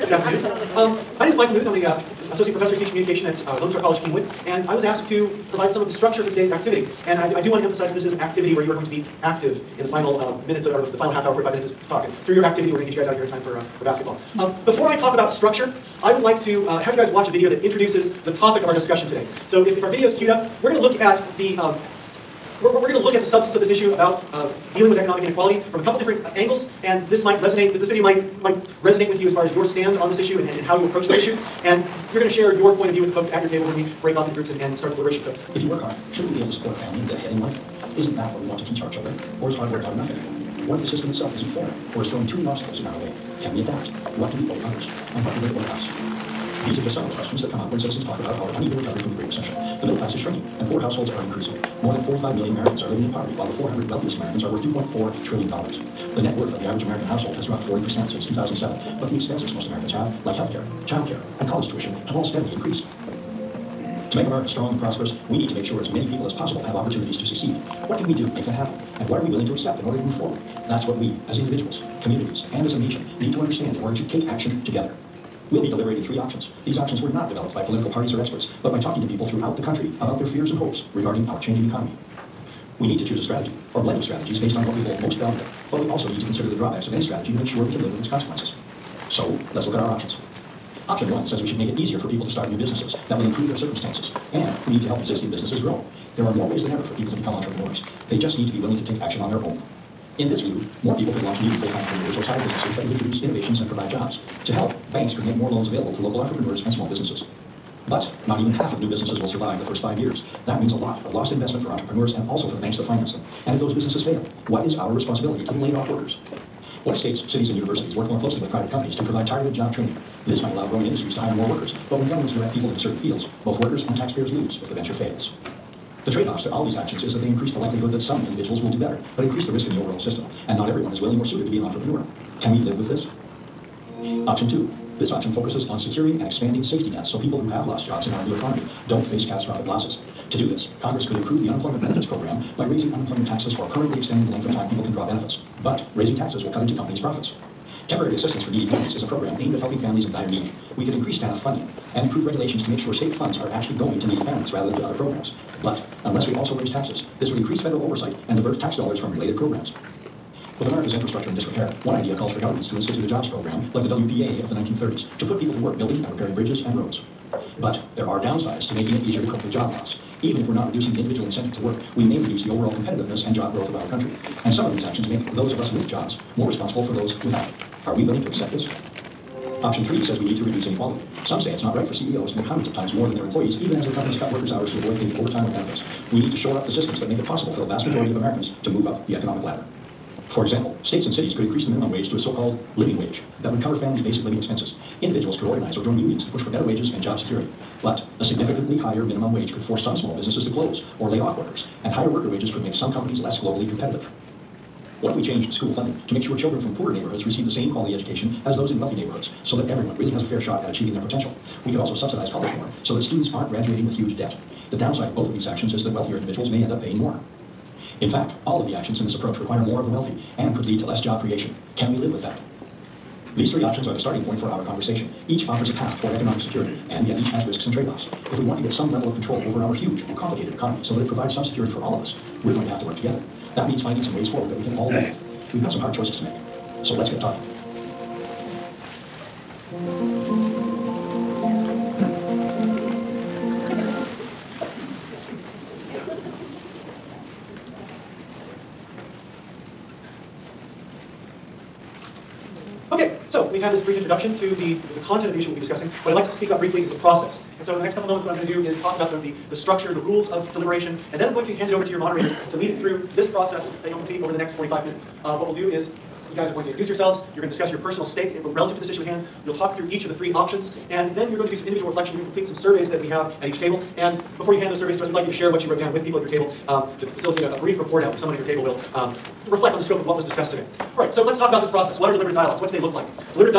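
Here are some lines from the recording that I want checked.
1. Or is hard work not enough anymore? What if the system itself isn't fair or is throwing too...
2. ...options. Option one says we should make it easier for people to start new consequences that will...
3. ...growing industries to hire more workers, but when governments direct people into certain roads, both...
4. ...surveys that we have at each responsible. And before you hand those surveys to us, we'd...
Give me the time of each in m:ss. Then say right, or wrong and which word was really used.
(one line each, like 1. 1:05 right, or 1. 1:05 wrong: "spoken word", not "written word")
1. 0:39 right
2. 1:29 wrong: "businesses", not "consequences"
3. 2:00 wrong: "fields", not "roads"
4. 4:32 wrong: "table", not "responsible".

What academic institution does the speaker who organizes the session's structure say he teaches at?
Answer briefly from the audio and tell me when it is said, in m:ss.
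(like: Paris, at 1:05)
Lone Star College Kingwood, at 0:03.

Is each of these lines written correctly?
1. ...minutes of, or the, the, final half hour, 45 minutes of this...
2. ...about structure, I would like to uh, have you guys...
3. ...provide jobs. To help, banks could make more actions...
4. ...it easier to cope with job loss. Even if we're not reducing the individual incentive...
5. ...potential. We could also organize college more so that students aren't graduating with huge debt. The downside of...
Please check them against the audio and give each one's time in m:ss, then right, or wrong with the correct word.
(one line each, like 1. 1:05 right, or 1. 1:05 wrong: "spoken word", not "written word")
1. 0:10 right
2. 0:15 right
3. 1:43 wrong: "loans", not "actions"
4. 2:48 right
5. 3:31 wrong: "subsidize", not "organize".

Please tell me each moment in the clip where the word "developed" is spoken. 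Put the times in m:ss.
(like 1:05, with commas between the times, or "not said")
1:17.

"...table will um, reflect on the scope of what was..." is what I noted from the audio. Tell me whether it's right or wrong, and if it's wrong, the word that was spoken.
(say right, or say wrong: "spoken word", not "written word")
right.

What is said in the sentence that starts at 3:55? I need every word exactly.
We've got some hard choices to make.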